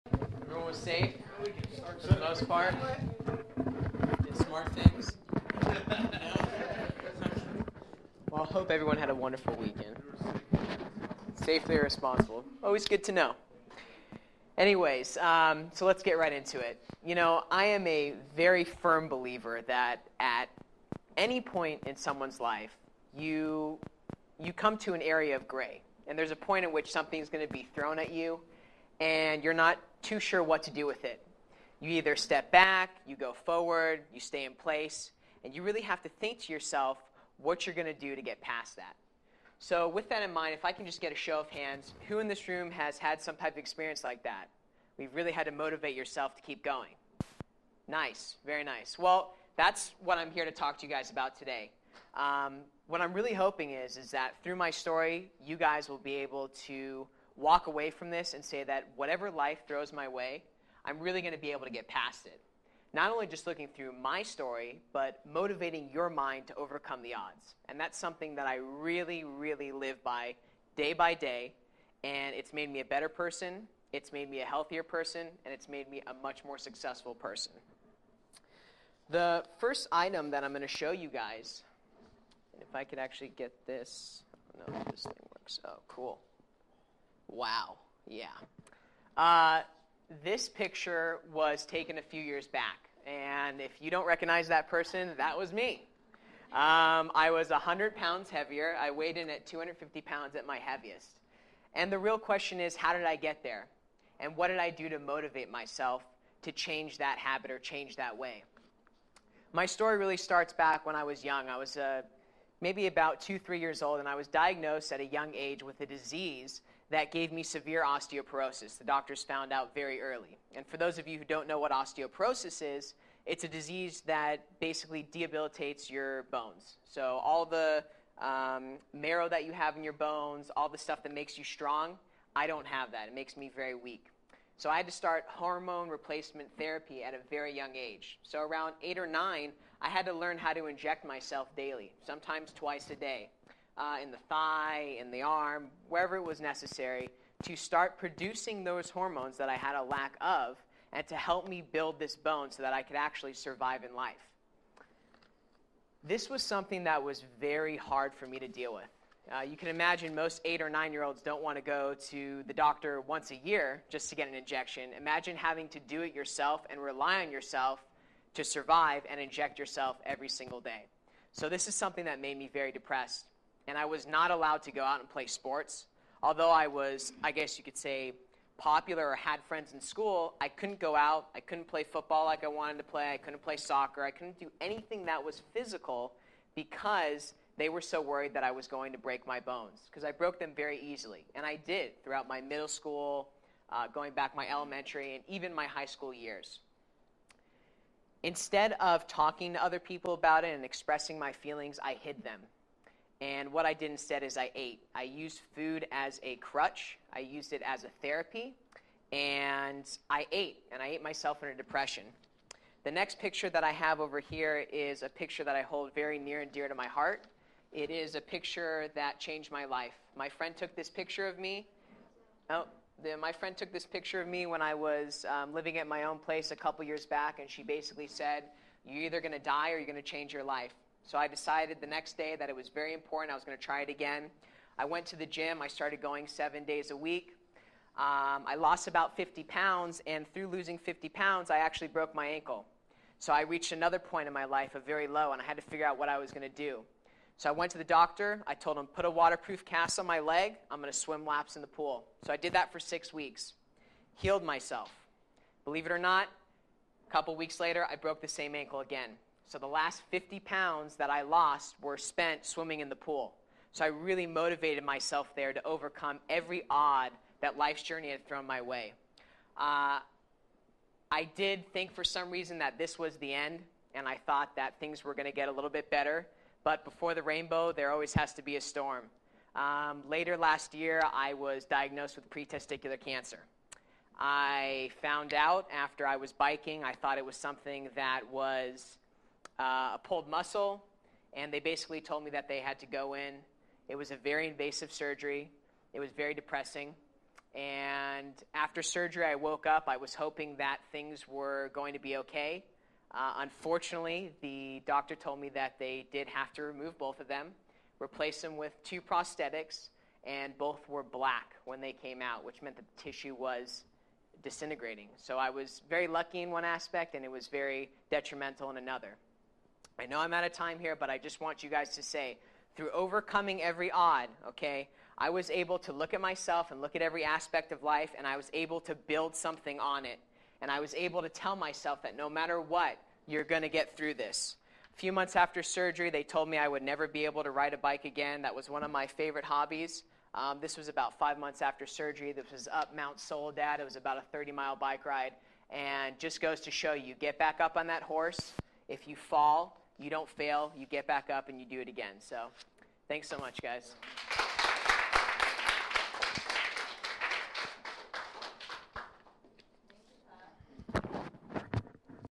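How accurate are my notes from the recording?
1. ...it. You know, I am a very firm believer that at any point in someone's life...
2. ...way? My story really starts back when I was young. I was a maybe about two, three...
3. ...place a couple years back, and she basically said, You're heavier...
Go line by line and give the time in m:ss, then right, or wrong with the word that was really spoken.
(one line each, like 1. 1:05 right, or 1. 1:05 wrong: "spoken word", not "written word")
1. 0:16 right
2. 1:48 right
3. 3:46 wrong: "either", not "heavier".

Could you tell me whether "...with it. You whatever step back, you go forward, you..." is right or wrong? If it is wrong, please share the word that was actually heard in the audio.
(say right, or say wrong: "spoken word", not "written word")
wrong: "either", not "whatever".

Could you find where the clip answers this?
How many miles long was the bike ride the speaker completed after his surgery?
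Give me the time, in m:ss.
5:44.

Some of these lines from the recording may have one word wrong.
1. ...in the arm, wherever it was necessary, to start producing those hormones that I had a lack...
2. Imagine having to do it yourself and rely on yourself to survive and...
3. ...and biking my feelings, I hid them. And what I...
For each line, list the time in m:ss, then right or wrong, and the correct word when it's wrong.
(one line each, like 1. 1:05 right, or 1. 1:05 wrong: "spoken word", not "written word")
1. 2:24 right
2. 2:44 right
3. 3:20 wrong: "expressing", not "biking".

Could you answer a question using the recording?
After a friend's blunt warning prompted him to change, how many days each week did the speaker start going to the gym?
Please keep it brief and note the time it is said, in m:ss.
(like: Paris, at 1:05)
7, at 3:56.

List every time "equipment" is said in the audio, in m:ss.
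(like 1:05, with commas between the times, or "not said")
not said.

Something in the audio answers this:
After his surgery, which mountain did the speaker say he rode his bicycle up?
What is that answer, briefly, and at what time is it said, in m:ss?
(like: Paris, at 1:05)
Mount Soledad, at 5:42.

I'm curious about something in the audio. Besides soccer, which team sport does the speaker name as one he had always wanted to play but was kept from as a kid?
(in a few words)
Football.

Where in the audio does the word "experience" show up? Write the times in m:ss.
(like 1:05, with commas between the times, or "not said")
0:43.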